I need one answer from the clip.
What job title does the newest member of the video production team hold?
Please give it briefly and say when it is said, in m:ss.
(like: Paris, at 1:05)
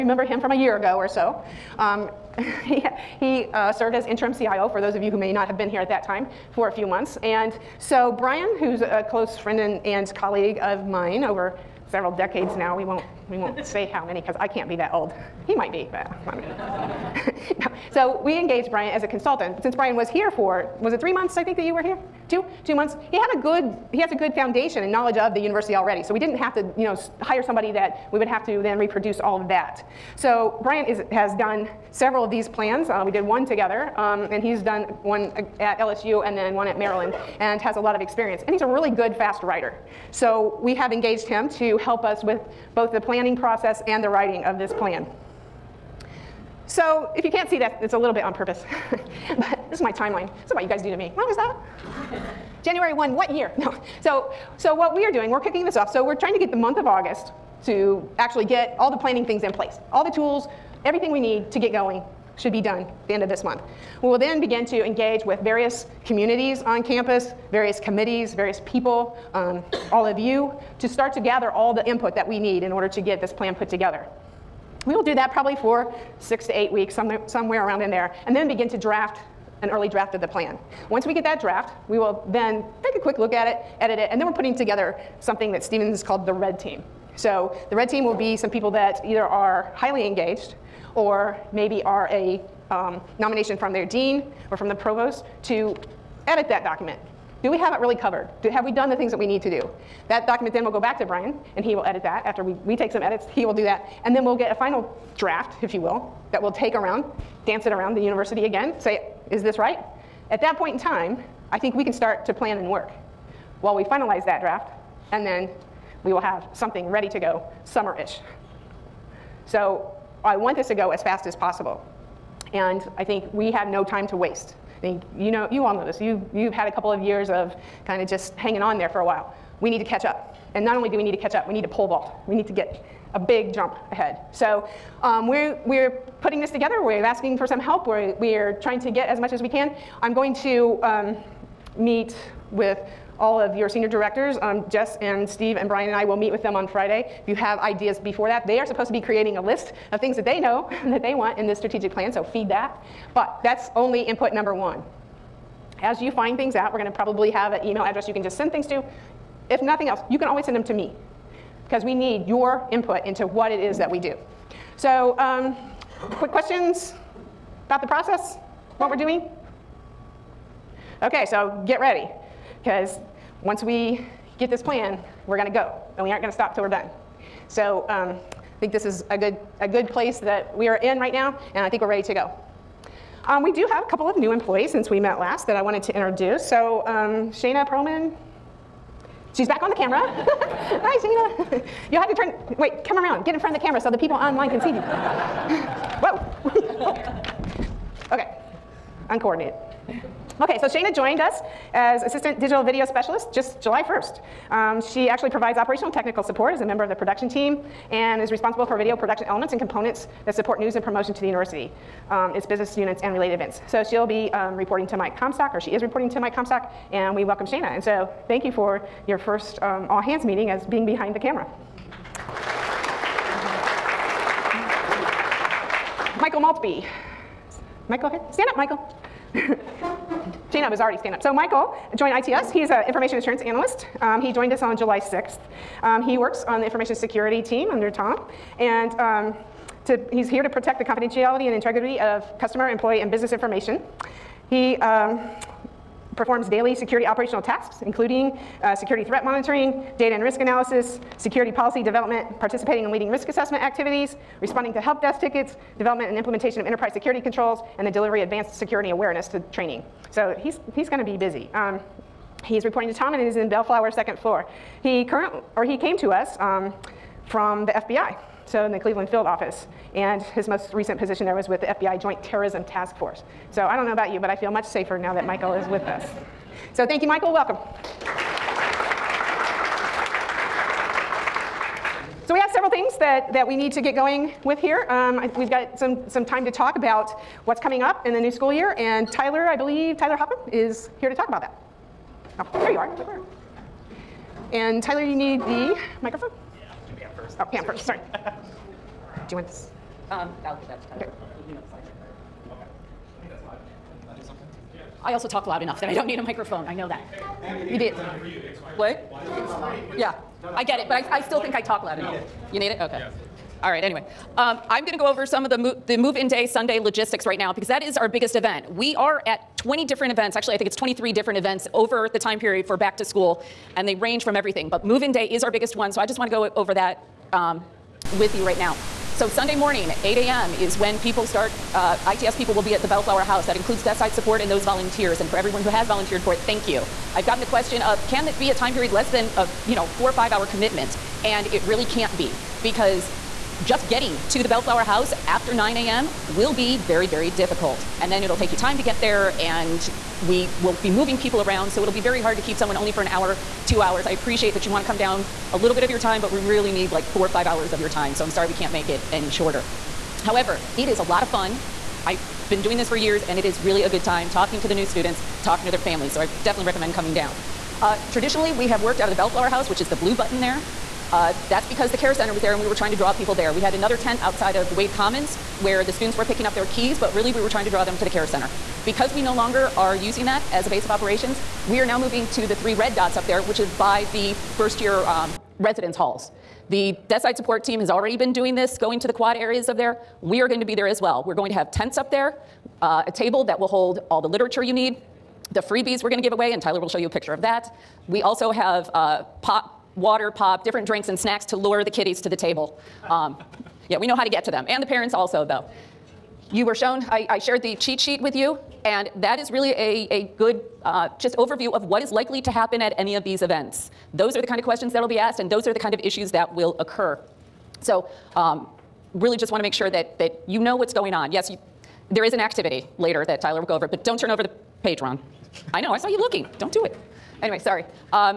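Assistant Digital Video Specialist, at 3:22.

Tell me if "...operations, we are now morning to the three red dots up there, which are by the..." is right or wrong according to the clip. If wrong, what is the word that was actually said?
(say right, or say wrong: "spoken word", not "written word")
wrong: "moving", not "morning".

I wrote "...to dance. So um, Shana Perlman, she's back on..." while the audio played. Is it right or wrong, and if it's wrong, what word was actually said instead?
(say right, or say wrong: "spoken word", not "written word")
wrong: "introduce", not "dance".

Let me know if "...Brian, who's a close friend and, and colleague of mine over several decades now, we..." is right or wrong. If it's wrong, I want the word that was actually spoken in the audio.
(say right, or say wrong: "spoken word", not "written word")
right.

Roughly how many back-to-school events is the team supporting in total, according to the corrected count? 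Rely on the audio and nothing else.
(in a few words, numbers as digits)
23.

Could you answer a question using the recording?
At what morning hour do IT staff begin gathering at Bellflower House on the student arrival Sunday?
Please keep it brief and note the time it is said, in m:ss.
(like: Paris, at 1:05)
8 a.m., at 5:30.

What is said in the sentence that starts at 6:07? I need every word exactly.
Uh, traditionally, we have worked out of the Bellflower House, which is the blue button there.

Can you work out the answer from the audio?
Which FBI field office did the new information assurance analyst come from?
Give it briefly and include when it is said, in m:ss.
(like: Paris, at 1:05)
Cleveland, at 4:28.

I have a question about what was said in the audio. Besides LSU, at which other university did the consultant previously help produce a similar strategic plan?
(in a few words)
Maryland.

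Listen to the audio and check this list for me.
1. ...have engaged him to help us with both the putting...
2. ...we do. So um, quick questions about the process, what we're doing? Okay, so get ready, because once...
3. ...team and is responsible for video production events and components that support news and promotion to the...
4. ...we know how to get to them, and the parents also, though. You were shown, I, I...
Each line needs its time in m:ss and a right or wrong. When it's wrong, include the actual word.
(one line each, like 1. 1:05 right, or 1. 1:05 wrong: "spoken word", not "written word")
1. 0:40 wrong: "planning", not "putting"
2. 2:43 right
3. 3:27 wrong: "elements", not "events"
4. 6:43 right.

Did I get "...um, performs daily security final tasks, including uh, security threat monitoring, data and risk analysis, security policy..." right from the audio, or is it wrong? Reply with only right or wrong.
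wrong.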